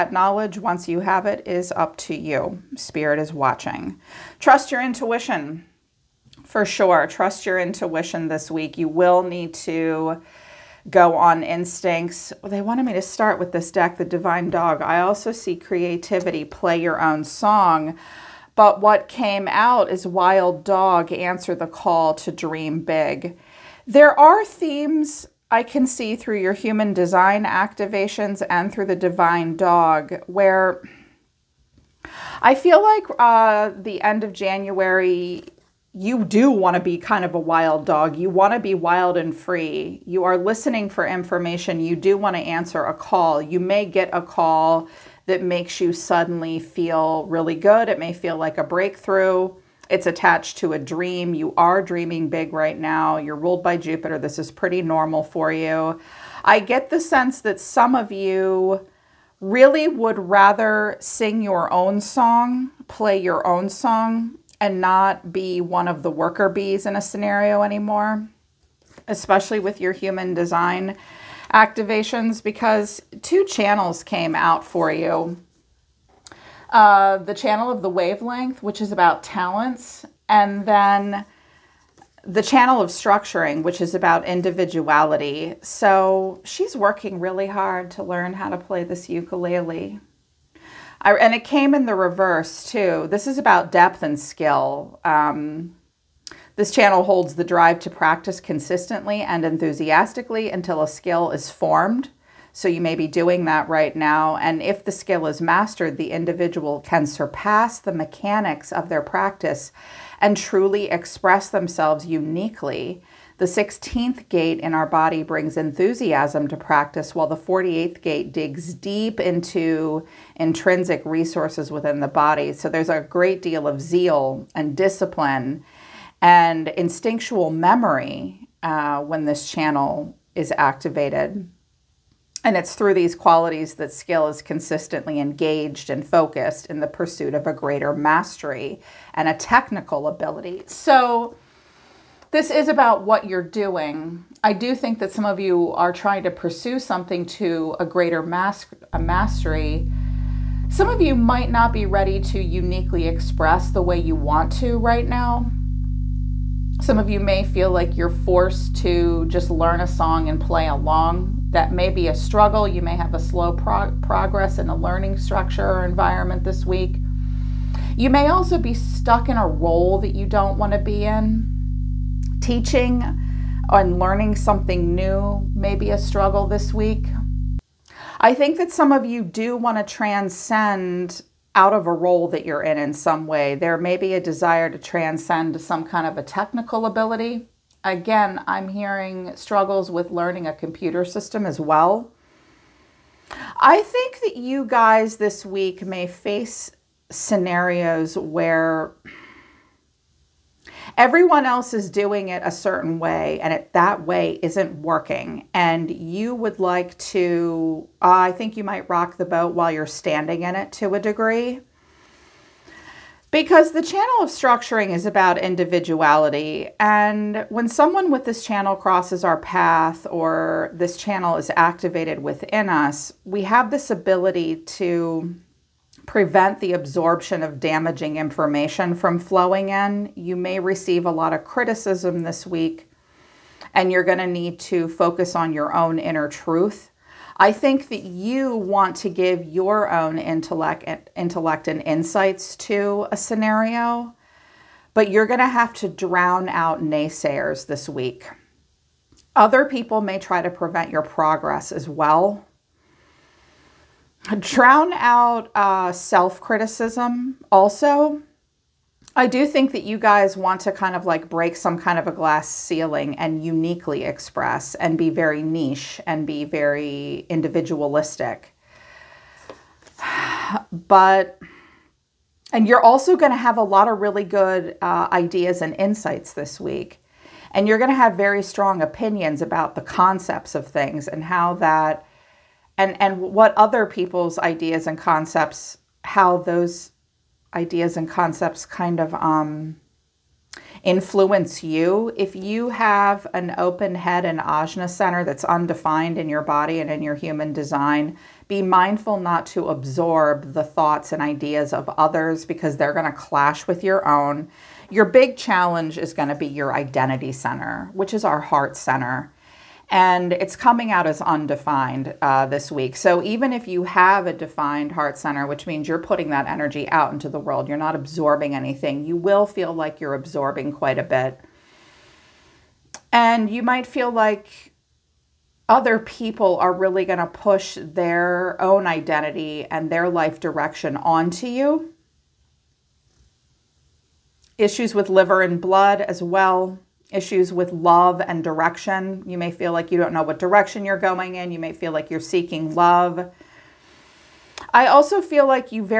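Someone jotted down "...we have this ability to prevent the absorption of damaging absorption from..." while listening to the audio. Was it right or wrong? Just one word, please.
wrong.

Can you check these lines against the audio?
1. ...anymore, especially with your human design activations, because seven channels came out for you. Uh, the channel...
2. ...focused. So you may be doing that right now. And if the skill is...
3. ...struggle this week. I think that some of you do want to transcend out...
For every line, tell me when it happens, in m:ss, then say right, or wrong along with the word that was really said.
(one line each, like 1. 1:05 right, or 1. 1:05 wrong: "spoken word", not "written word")
1. 1:07 wrong: "two", not "seven"
2. 1:41 wrong: "formed", not "focused"
3. 2:55 right.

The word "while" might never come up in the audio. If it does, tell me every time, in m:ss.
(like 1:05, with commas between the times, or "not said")
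1:57, 3:29.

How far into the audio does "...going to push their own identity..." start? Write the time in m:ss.
5:27.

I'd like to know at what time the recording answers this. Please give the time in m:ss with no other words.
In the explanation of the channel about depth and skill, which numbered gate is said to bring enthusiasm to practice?
1:53.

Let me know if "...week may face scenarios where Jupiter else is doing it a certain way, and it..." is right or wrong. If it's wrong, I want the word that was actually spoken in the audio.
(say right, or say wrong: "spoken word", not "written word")
wrong: "Everyone", not "Jupiter".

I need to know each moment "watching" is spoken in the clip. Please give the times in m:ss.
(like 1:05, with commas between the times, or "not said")
0:03.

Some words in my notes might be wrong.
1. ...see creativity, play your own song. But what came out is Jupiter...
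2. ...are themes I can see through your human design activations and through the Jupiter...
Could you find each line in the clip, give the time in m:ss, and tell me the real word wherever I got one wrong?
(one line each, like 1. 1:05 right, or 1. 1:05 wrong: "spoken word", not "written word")
1. 0:15 wrong: "Wild", not "Jupiter"
2. 0:24 wrong: "Divine", not "Jupiter".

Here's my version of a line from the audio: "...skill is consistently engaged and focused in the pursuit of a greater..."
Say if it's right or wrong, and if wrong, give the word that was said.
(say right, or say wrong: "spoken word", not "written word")
right.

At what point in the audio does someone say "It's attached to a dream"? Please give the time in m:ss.
0:49.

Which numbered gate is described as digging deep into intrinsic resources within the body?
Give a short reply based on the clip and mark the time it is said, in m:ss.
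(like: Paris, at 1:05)
48th gate, at 1:57.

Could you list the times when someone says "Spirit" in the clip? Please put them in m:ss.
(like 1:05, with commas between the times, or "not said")
0:02.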